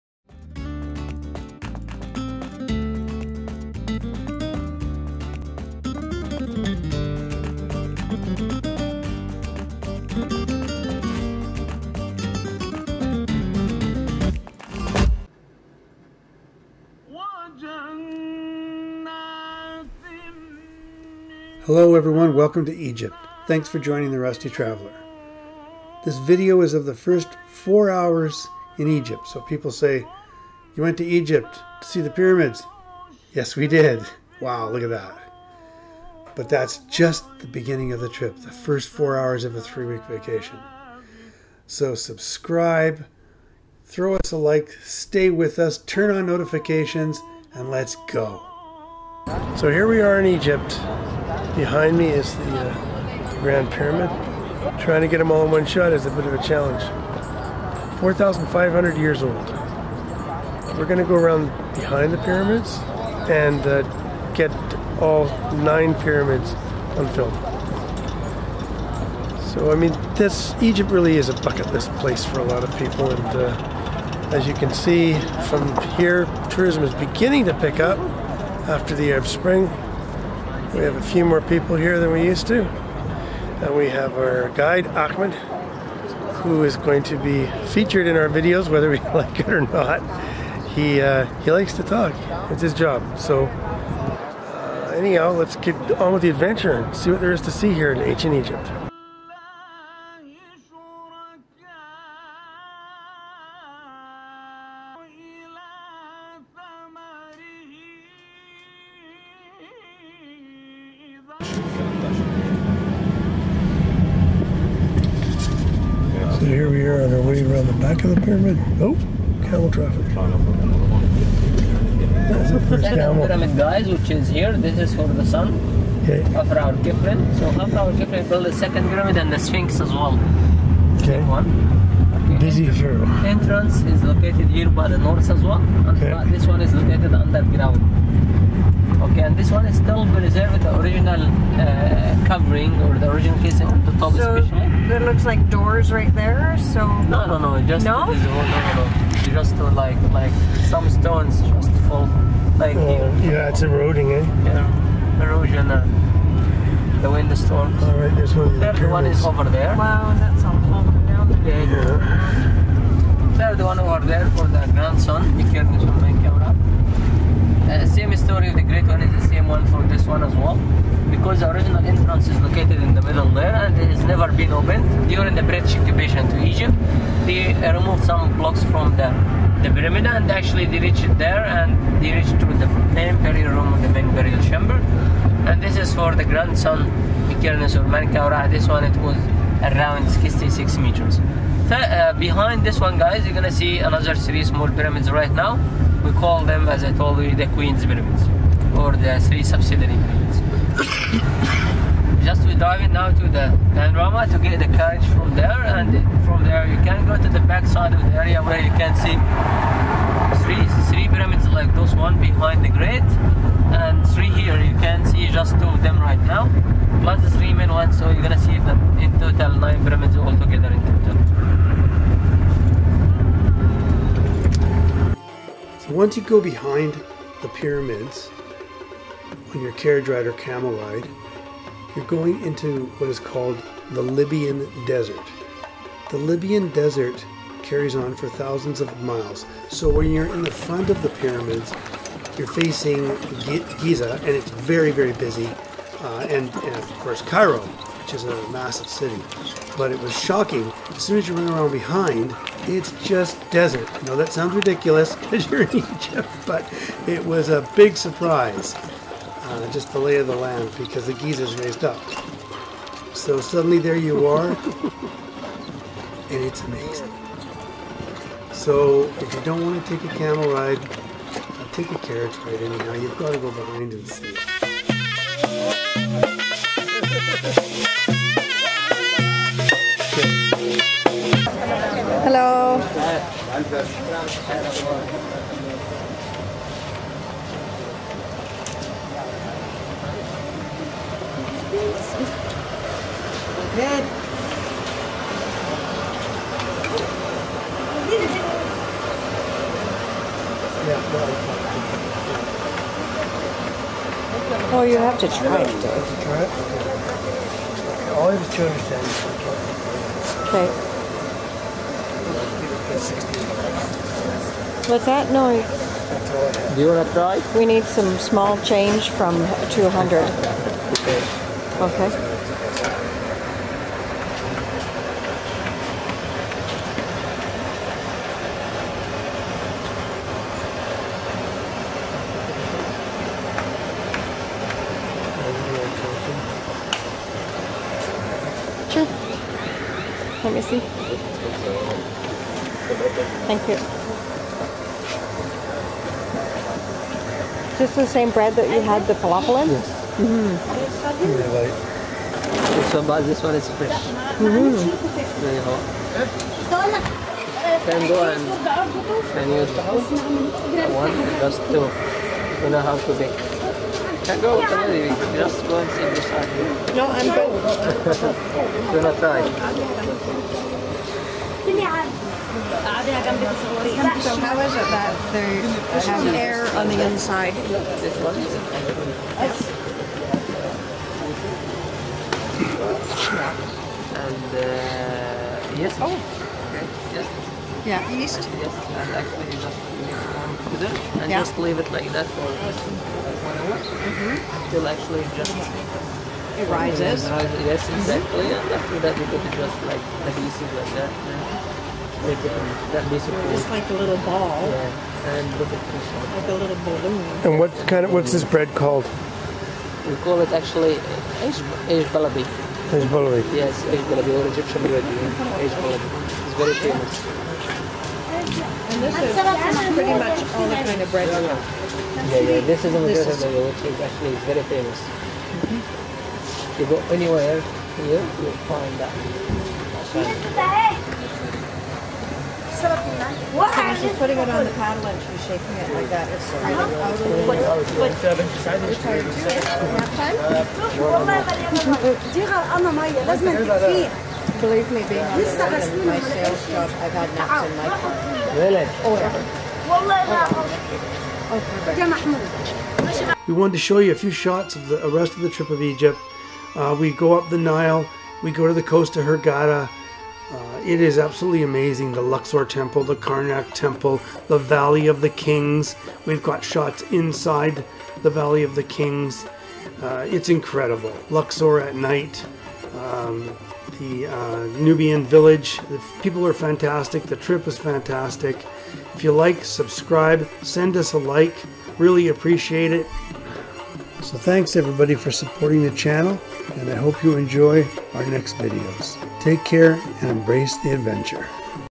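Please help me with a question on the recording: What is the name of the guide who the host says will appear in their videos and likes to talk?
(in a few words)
Ahmed.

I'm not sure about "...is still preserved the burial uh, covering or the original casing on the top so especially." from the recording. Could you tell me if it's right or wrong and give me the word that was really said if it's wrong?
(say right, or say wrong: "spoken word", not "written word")
wrong: "original", not "burial".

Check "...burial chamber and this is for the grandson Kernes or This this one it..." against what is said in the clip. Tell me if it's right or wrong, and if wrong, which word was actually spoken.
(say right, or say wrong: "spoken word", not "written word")
wrong: "Menkaura", not "This".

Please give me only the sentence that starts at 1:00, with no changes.
We're going to go around behind the pyramids and uh, get all nine pyramids on film.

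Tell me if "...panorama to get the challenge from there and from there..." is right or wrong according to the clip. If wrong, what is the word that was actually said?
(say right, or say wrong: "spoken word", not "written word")
wrong: "carriage", not "challenge".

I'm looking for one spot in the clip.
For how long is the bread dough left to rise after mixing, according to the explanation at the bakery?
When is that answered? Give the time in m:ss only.
6:32.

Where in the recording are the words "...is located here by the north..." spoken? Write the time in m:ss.
2:13.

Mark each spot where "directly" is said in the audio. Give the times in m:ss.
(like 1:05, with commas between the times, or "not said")
not said.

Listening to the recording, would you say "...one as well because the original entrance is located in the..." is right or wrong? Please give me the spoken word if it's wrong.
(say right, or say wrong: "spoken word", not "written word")
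right.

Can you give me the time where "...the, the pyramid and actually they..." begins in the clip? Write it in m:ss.
2:58.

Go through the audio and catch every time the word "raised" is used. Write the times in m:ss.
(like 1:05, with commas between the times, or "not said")
4:21.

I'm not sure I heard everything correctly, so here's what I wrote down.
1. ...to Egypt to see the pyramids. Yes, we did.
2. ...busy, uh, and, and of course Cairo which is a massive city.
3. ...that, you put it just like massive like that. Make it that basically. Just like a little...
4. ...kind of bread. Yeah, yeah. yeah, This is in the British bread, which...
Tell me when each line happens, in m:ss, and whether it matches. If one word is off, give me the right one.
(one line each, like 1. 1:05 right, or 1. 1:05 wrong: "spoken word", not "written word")
1. 0:30 right
2. 4:05 right
3. 6:39 wrong: "adhesive", not "massive"
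4. 7:00 wrong: "Egyptian", not "British".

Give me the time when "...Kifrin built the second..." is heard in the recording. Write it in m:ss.
2:07.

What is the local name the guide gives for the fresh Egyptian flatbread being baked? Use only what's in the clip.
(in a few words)
Eish Baladi.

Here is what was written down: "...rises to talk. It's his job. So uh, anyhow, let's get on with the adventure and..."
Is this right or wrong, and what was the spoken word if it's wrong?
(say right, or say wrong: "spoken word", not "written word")
wrong: "likes", not "rises".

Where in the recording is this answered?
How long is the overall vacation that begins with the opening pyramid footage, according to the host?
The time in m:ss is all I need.
0:39.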